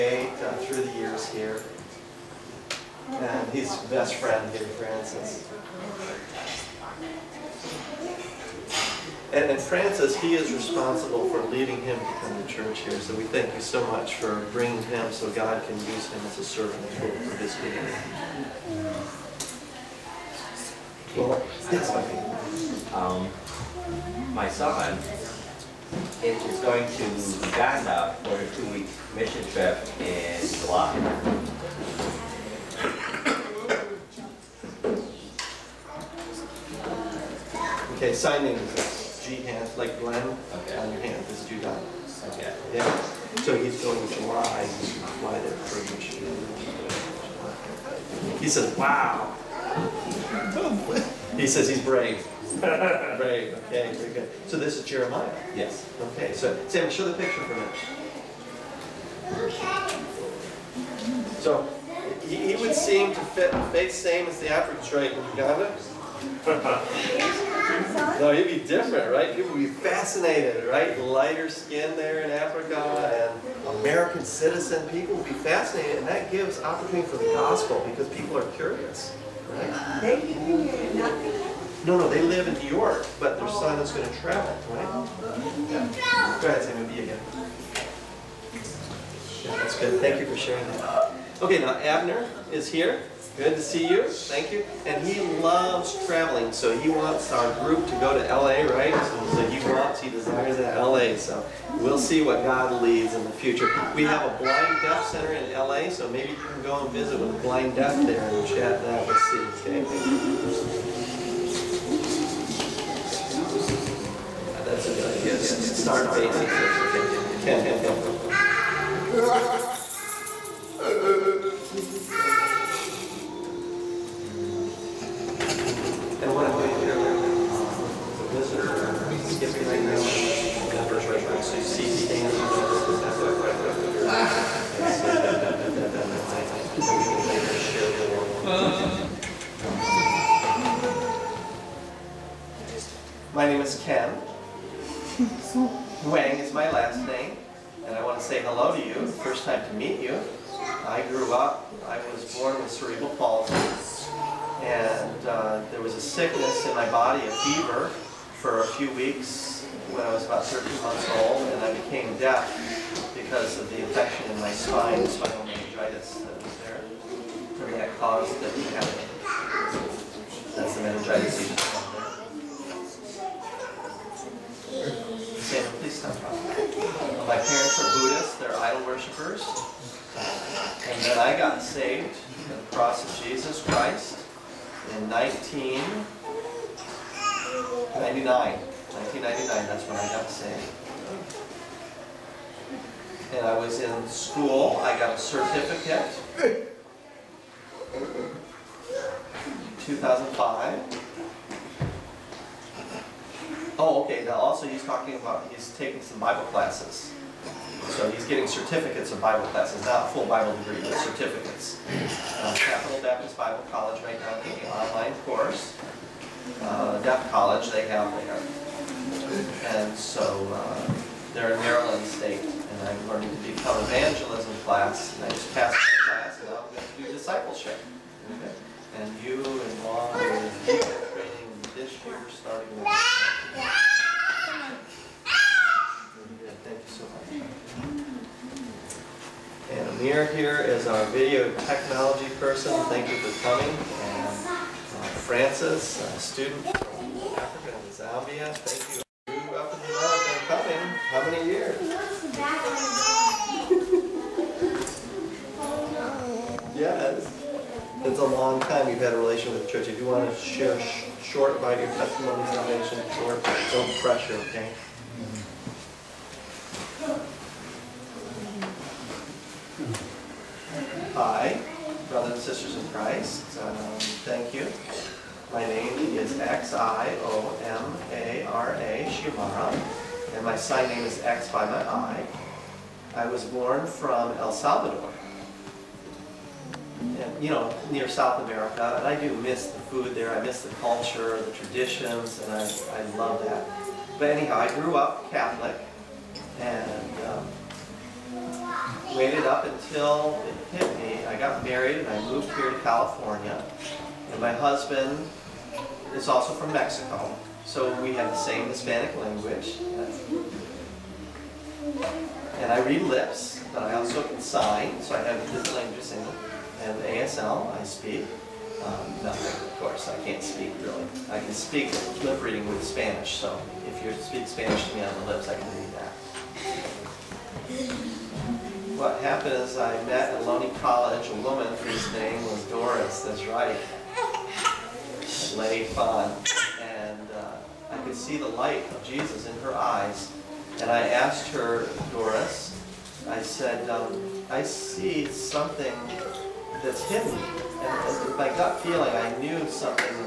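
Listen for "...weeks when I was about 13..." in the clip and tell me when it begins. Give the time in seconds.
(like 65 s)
158 s.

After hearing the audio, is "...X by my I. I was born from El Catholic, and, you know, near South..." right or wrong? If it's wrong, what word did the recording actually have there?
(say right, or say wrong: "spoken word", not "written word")
wrong: "Salvador", not "Catholic".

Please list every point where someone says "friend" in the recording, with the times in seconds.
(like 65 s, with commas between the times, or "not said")
4 s.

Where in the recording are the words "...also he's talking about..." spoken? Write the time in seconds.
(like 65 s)
204 s.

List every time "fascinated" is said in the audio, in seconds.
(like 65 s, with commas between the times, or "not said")
69 s, 75 s.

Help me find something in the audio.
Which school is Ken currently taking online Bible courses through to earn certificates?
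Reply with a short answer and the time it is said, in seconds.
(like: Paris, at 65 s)
Capital Baptist Bible College, at 212 s.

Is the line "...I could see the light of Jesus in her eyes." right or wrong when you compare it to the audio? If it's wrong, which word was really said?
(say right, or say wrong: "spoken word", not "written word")
right.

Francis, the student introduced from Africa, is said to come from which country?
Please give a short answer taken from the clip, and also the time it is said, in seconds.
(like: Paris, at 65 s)
Zambia, at 247 s.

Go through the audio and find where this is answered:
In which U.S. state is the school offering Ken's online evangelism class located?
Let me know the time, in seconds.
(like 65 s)
221 s.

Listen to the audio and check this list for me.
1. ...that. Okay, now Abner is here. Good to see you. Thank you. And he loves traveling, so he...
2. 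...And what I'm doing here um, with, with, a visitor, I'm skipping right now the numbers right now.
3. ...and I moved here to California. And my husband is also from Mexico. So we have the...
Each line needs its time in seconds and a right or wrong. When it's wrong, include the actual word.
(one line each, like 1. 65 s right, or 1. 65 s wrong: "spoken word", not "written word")
1. 90 s right
2. 126 s right
3. 301 s right.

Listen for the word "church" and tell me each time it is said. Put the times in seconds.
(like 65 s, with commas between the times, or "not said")
12 s, 259 s.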